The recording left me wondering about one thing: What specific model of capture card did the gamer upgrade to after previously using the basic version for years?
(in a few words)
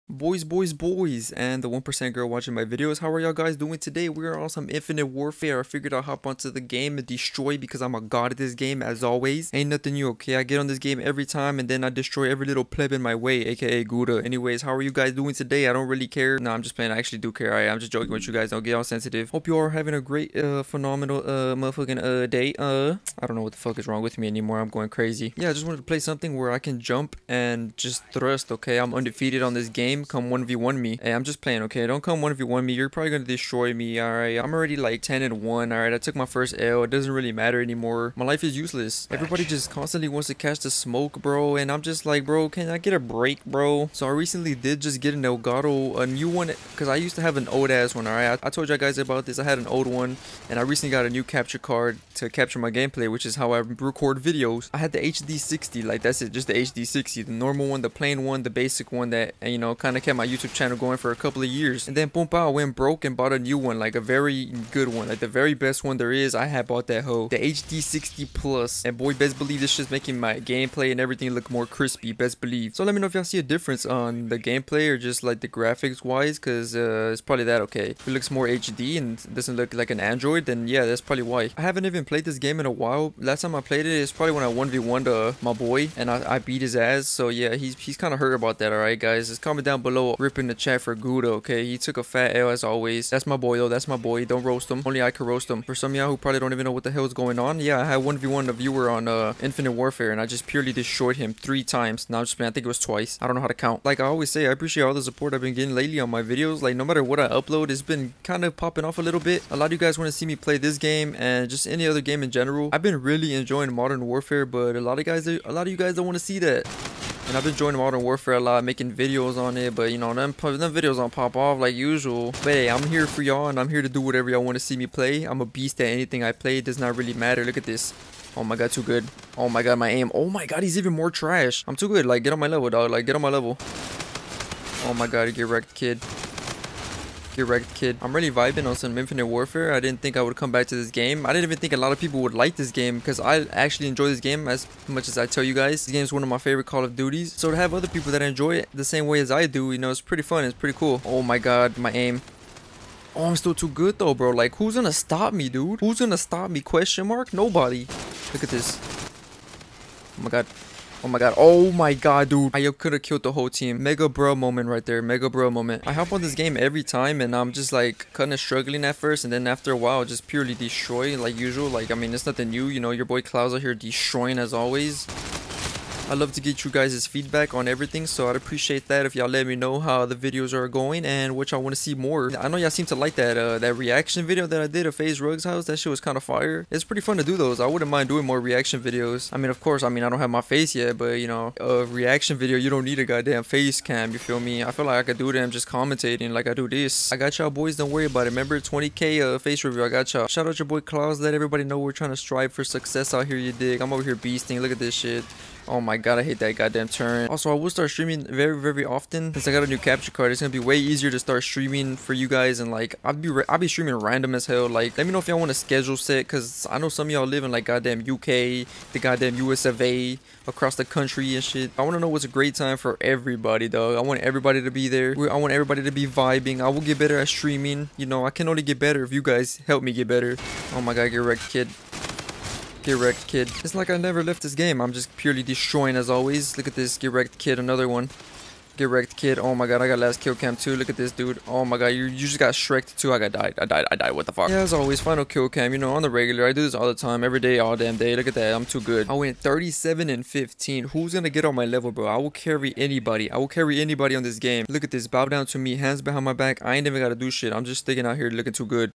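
HD 60 Plus.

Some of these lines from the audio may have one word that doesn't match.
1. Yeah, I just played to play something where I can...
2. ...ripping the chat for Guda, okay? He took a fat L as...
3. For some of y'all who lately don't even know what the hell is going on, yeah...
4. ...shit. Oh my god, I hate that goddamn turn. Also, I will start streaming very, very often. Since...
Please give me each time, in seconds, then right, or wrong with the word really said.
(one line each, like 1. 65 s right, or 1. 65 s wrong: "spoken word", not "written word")
1. 25 s wrong: "wanted", not "played"
2. 90 s right
3. 95 s wrong: "probably", not "lately"
4. 204 s right.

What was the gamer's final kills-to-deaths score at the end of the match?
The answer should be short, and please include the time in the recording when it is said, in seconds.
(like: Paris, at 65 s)
37 and 15, at 249 s.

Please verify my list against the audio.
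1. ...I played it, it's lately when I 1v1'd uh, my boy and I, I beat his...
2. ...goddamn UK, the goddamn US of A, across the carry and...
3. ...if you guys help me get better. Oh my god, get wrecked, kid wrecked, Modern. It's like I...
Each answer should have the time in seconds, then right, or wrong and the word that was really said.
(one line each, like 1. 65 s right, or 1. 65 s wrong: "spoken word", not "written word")
1. 83 s wrong: "probably", not "lately"
2. 217 s wrong: "country", not "carry"
3. 229 s wrong: "Kid", not "Modern".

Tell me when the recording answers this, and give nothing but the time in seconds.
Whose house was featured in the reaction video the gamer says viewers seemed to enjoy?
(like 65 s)
184 s.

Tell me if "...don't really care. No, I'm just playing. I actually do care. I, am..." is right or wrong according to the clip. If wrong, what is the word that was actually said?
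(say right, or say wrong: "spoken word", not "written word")
right.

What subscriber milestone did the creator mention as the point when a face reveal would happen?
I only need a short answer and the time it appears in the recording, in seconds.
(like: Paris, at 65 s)
20k, at 198 s.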